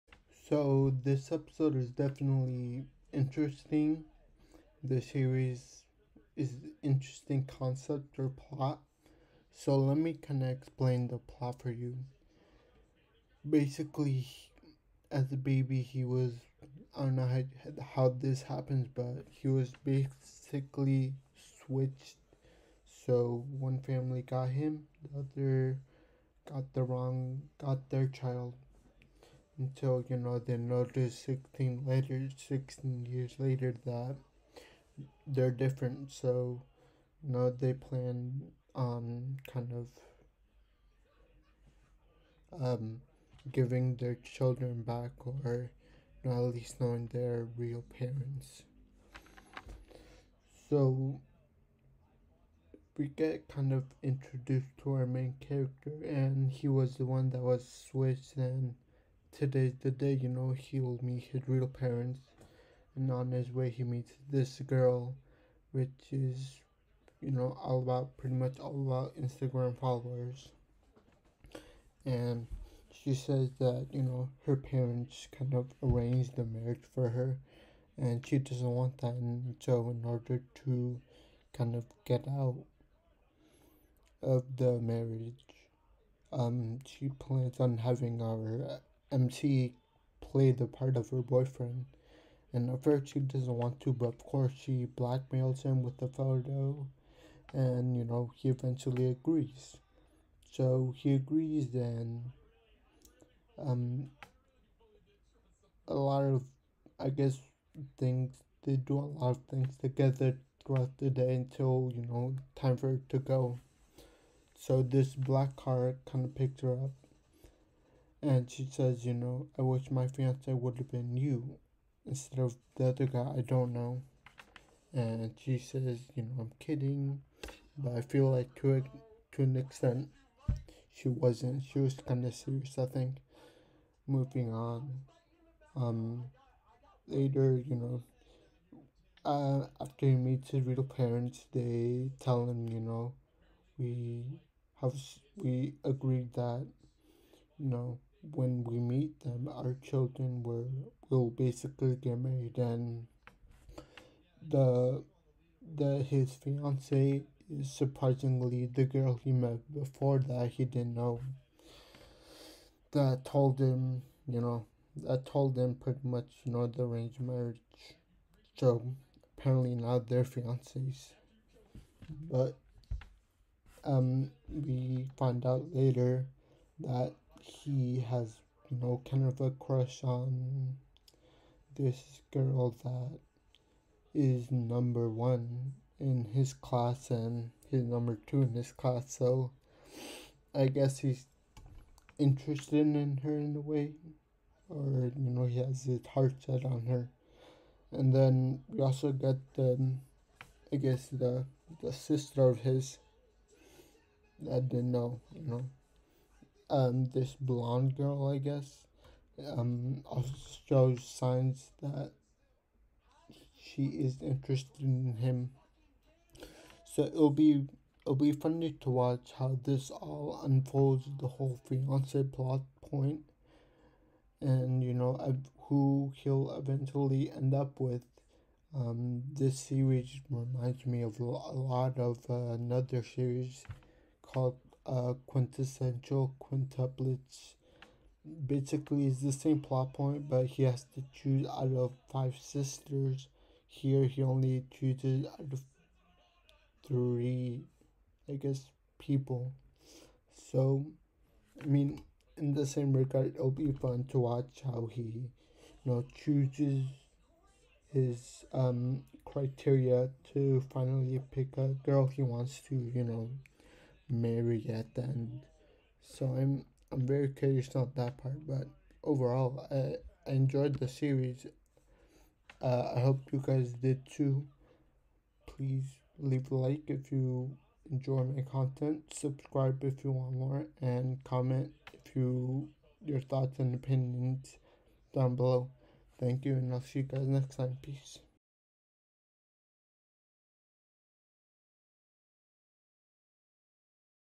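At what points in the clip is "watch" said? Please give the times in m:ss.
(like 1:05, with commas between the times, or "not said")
3:38, 4:14.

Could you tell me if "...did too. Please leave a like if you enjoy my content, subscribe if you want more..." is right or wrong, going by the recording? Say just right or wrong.
right.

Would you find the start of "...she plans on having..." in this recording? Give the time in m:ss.
1:26.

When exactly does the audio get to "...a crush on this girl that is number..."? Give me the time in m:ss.
2:59.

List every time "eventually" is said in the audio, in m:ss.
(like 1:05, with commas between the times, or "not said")
1:38, 3:46.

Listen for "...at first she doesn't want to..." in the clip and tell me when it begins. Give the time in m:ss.
1:32.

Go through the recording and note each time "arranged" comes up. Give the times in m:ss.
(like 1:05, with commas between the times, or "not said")
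1:15, 2:46.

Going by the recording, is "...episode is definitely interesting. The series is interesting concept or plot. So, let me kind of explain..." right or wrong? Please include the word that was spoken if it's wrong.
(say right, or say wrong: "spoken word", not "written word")
right.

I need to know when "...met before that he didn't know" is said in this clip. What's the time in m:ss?
2:39.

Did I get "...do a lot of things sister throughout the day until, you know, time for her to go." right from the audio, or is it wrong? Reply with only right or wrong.
wrong.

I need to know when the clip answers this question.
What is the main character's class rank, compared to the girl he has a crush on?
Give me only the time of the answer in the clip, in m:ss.
3:07.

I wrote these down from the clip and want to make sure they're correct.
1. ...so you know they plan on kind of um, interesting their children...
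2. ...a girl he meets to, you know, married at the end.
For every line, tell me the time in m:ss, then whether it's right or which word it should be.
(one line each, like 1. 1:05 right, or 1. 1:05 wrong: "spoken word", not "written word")
1. 0:36 wrong: "giving", not "interesting"
2. 4:21 wrong: "wants", not "meets".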